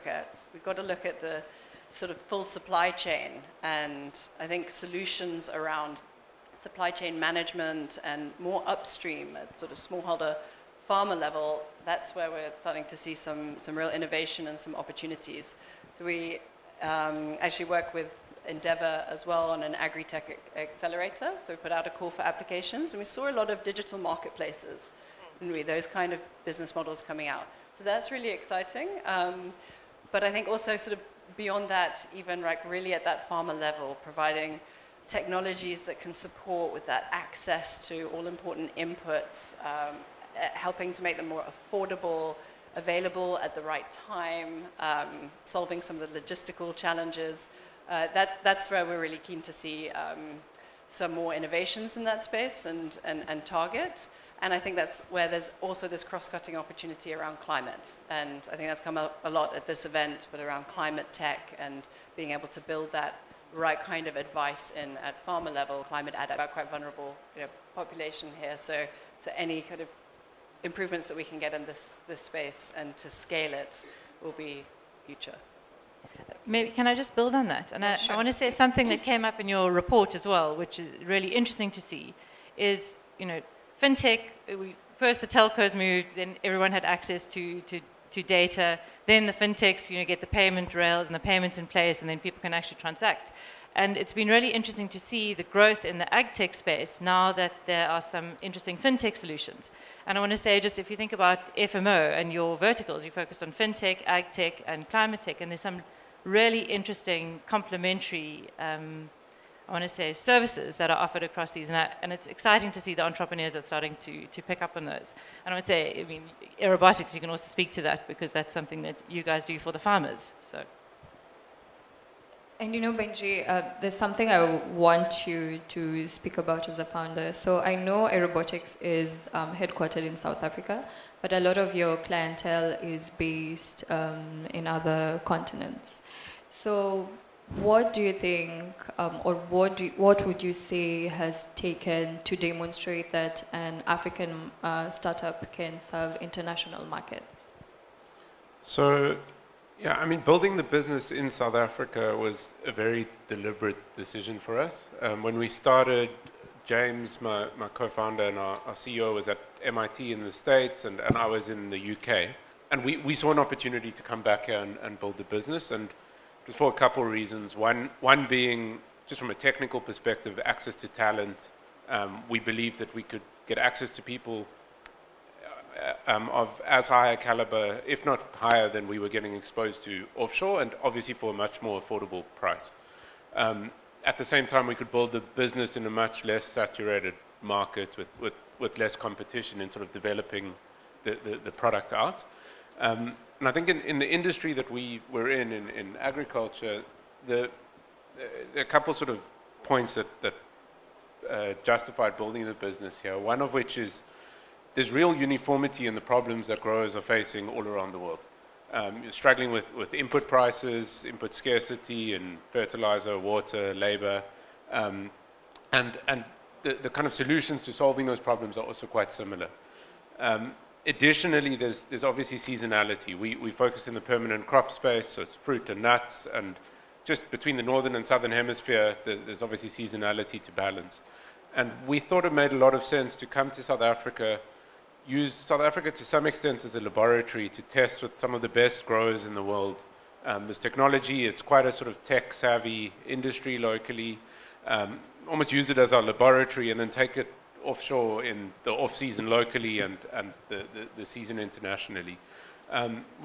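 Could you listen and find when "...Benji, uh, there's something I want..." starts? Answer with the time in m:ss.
2:02.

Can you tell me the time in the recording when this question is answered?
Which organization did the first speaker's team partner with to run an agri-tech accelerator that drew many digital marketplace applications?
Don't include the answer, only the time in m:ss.
0:18.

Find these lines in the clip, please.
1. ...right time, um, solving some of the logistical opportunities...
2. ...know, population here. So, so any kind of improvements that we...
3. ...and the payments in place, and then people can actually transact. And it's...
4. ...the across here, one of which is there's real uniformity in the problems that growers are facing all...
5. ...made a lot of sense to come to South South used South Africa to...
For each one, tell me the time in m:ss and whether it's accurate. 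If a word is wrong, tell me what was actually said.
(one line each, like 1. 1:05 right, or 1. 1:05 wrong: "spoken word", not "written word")
1. 0:43 wrong: "challenges", not "opportunities"
2. 1:07 right
3. 1:31 right
4. 3:22 wrong: "business", not "across"
5. 3:52 wrong: "Africa", not "South".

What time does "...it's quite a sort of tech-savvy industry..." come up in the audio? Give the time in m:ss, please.
4:01.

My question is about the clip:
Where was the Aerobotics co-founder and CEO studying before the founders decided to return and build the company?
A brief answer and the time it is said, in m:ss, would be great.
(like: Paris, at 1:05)
MIT, at 2:39.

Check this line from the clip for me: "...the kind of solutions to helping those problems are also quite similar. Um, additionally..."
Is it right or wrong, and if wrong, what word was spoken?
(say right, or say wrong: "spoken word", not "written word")
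wrong: "solving", not "helping".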